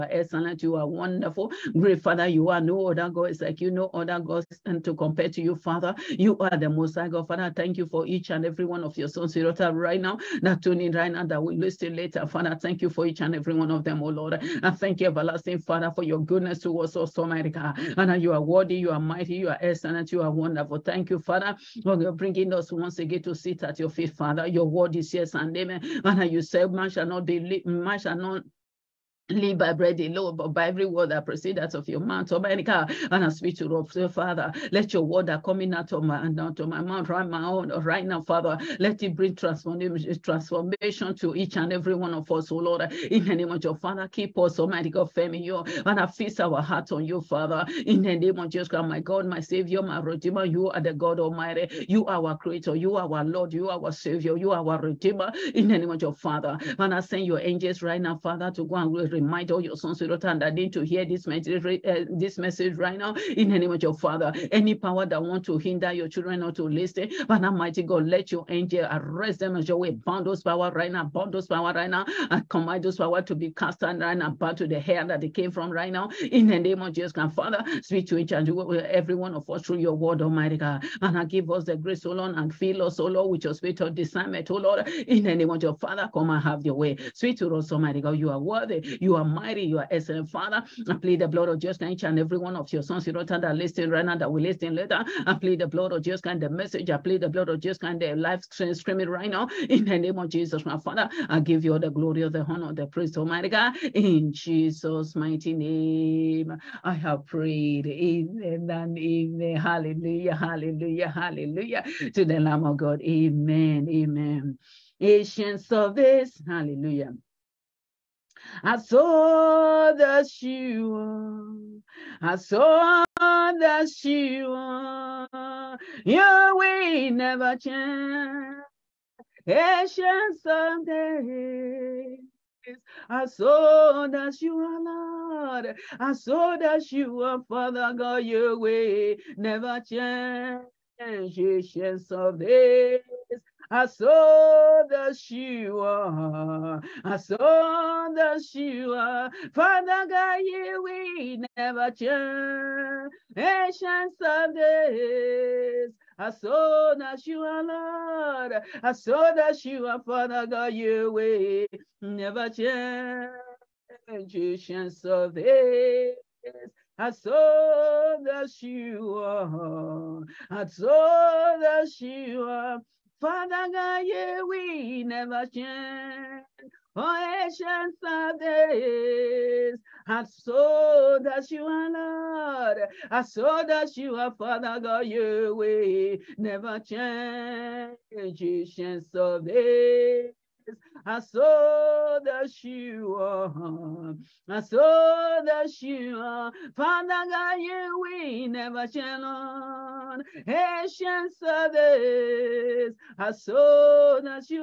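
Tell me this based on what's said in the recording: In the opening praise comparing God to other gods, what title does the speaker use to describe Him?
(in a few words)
Most High God.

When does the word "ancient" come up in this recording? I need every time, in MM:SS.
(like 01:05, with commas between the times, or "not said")
02:09, 02:20, 02:33, 02:44, 02:57, 03:08, 03:20.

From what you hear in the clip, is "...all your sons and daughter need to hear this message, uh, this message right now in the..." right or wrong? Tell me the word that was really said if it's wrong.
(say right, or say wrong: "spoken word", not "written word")
wrong: "under", not "daughter".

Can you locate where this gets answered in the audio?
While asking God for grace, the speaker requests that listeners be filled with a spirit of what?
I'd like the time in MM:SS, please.
01:23.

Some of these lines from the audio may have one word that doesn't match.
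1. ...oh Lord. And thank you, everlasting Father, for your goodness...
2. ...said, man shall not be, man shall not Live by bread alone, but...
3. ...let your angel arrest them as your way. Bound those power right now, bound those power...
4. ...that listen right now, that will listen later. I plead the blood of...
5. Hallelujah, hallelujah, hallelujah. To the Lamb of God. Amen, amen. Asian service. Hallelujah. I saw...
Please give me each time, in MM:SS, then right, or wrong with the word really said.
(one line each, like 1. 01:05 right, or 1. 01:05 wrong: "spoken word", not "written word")
1. 00:14 right
2. 00:26 right
3. 01:08 right
4. 01:33 right
5. 01:49 right.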